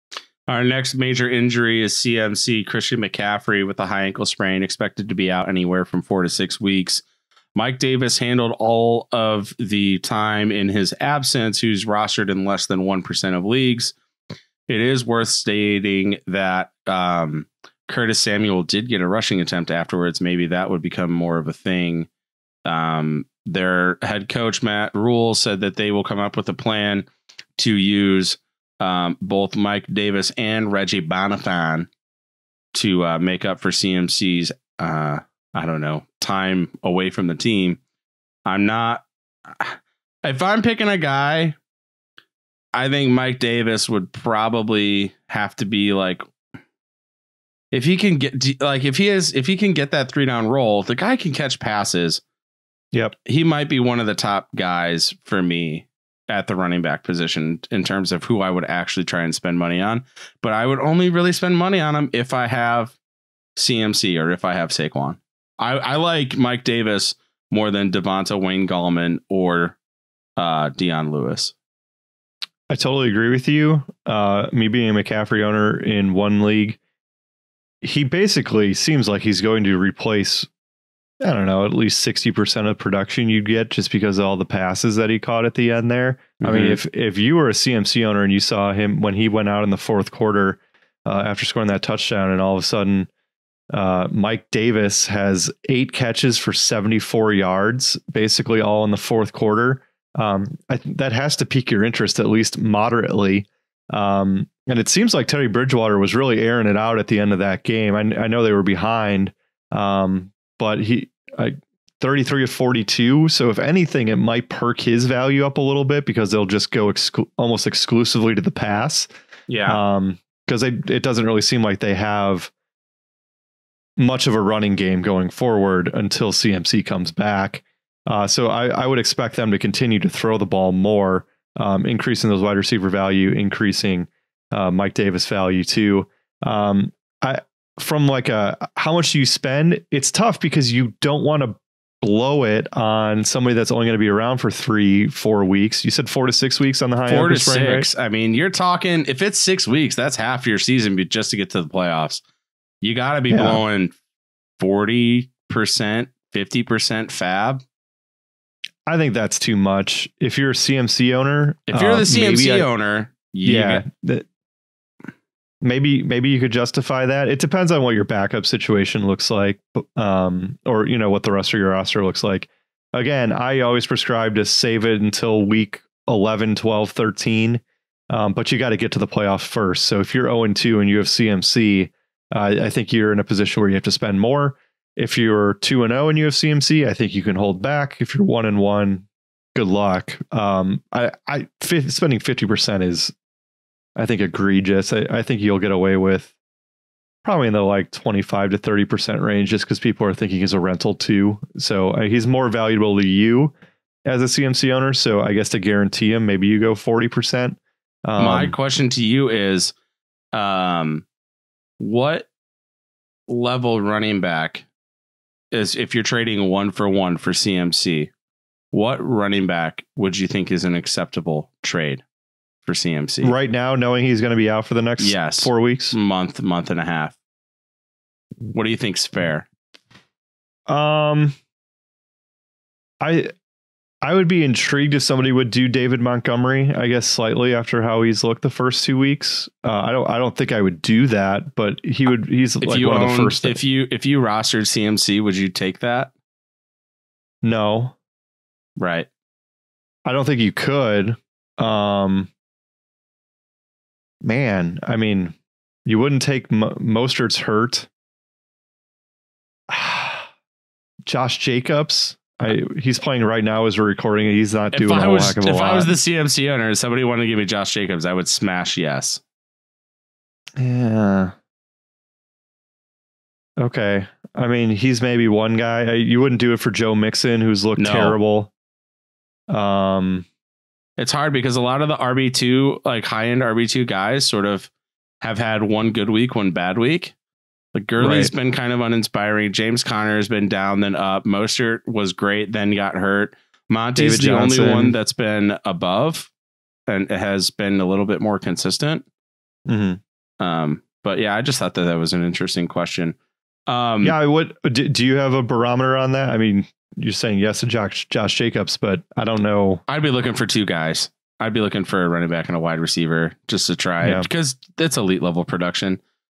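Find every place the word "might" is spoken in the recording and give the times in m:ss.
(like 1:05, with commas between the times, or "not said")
0:53, 1:54.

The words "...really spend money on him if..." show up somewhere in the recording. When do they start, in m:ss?
1:01.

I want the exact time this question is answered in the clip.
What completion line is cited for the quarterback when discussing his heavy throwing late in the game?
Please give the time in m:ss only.
1:52.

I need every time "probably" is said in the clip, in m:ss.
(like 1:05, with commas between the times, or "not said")
0:44, 3:17.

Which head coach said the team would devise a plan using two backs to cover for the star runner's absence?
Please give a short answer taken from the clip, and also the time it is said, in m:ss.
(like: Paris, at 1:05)
Matt Rhule, at 0:24.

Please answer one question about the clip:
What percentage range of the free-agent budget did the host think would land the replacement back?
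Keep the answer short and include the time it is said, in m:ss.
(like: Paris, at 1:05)
25 to 30%, at 3:17.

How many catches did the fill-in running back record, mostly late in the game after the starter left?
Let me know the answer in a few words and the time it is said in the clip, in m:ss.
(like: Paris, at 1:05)
8, at 1:35.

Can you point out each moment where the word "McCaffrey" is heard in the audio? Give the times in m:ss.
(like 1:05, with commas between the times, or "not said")
0:02, 1:14.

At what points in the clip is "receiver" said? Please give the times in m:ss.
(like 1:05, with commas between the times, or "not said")
2:12, 5:12.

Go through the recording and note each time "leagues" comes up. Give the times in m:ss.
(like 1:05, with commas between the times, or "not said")
0:13, 1:16.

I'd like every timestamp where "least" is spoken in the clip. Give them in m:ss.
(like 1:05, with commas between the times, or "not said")
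1:21, 1:42.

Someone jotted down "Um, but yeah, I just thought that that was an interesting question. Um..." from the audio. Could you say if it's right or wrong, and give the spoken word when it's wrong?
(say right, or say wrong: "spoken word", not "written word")
right.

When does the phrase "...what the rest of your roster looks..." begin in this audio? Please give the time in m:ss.
2:51.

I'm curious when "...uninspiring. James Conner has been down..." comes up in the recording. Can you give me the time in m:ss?
4:48.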